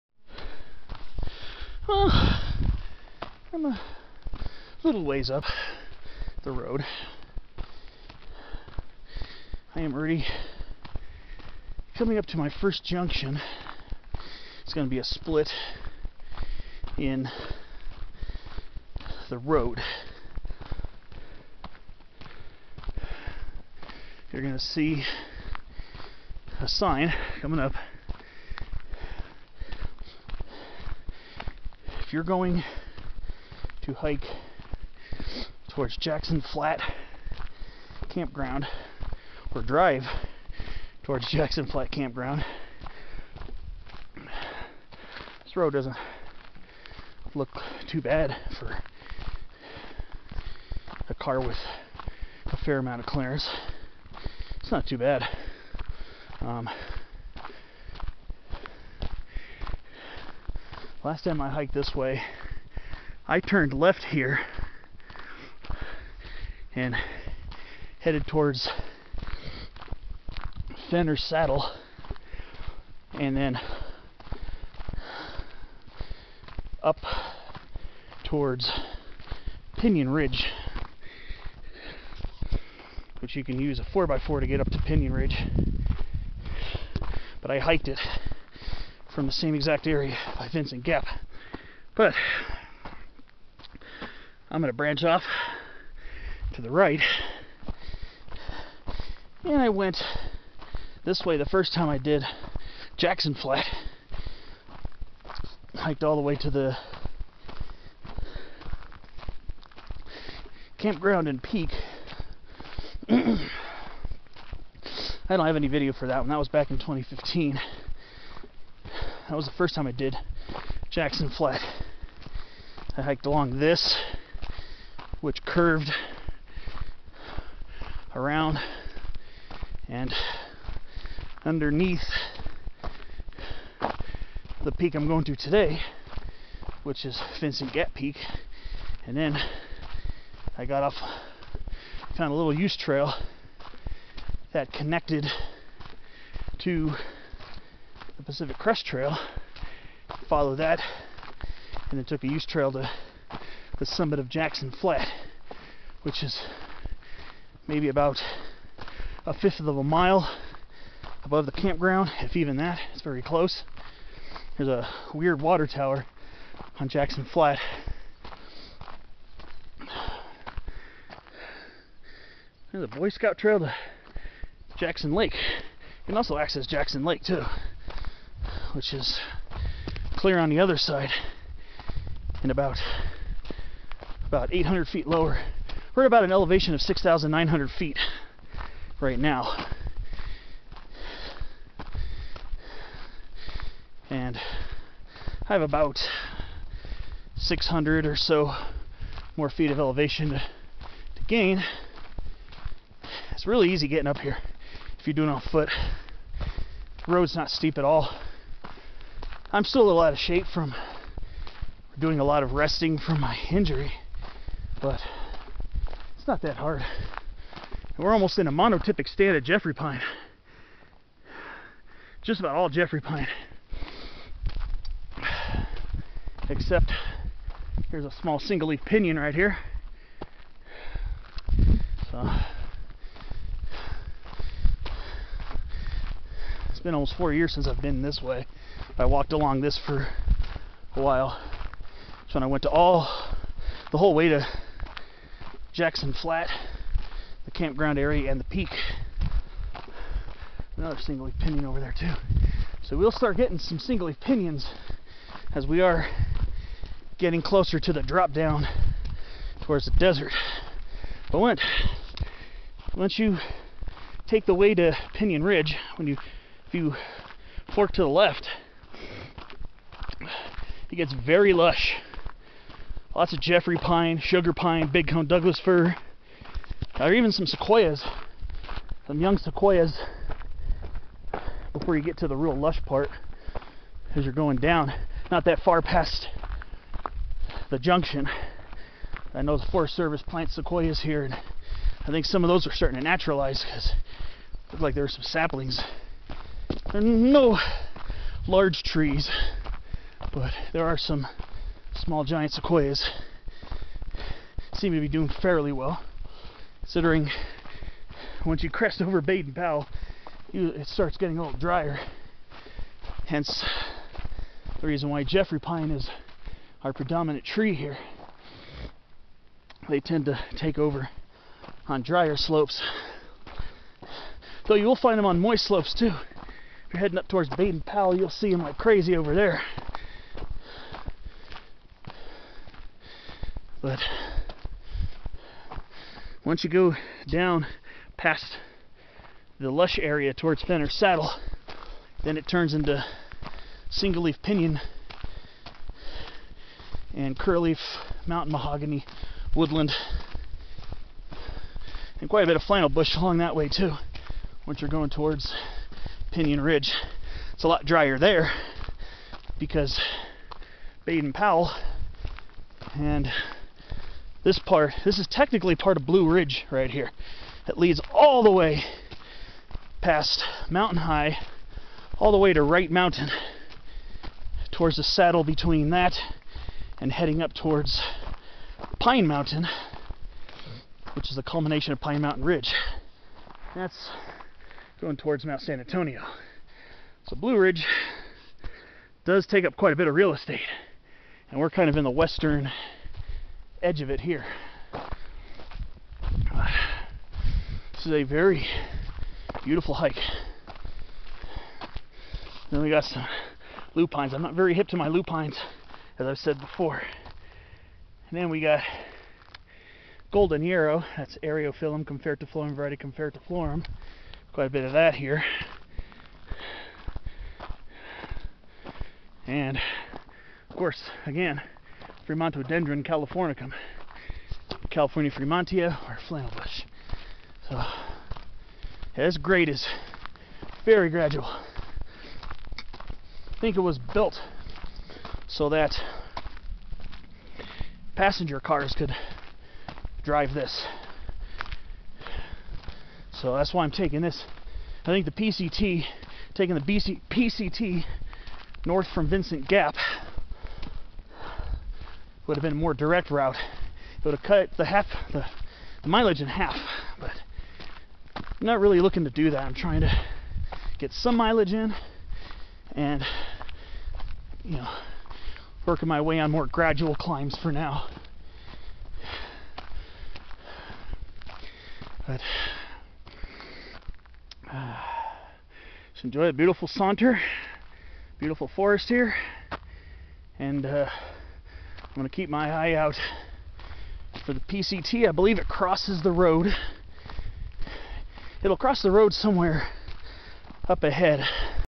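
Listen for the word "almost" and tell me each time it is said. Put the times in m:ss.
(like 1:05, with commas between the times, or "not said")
3:38, 3:56.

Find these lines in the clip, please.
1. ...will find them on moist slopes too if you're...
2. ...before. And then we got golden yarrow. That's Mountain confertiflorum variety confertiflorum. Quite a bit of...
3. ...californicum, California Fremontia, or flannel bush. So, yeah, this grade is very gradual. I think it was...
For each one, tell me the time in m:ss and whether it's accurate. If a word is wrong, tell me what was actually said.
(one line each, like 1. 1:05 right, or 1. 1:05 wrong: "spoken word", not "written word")
1. 5:24 right
2. 6:46 wrong: "Eriophyllum", not "Mountain"
3. 7:03 right.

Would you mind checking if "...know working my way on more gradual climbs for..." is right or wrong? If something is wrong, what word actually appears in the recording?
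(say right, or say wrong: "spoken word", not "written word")
right.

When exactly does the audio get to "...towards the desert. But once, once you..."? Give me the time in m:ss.
4:19.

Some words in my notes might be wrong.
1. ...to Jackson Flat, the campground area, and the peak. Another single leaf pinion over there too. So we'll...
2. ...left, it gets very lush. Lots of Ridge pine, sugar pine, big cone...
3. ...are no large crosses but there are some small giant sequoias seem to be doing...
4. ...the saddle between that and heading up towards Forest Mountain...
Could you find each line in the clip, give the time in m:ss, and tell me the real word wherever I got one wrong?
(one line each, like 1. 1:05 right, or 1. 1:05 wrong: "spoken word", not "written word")
1. 4:04 right
2. 4:28 wrong: "Jeffrey", not "Ridge"
3. 4:56 wrong: "trees", not "crosses"
4. 6:14 wrong: "Pine", not "Forest".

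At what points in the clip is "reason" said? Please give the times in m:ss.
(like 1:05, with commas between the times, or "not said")
5:14.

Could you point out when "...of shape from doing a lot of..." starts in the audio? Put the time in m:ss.
3:30.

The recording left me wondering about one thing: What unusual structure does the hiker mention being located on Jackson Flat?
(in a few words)
water tower.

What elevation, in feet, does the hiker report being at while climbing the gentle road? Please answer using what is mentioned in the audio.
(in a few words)
6,900 feet.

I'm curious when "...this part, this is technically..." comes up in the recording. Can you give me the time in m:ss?
6:04.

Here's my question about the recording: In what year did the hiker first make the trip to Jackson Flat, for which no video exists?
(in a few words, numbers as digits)
2015.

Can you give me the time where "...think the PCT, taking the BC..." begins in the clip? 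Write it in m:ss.
7:25.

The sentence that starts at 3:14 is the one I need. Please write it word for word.
And I have about 600 or so more feet of elevation to, to gain.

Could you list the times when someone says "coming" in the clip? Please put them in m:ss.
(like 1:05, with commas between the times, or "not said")
0:11, 0:27.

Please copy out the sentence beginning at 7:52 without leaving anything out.
But uh, just enjoy a beautiful saunter, beautiful forest here, and uh, I'm going to keep my eye out for the PCT.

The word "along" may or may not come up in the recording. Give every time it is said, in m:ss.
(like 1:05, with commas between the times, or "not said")
2:03, 3:59, 5:53.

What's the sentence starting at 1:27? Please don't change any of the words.
But I hiked it from the same exact area by Vincent Gap.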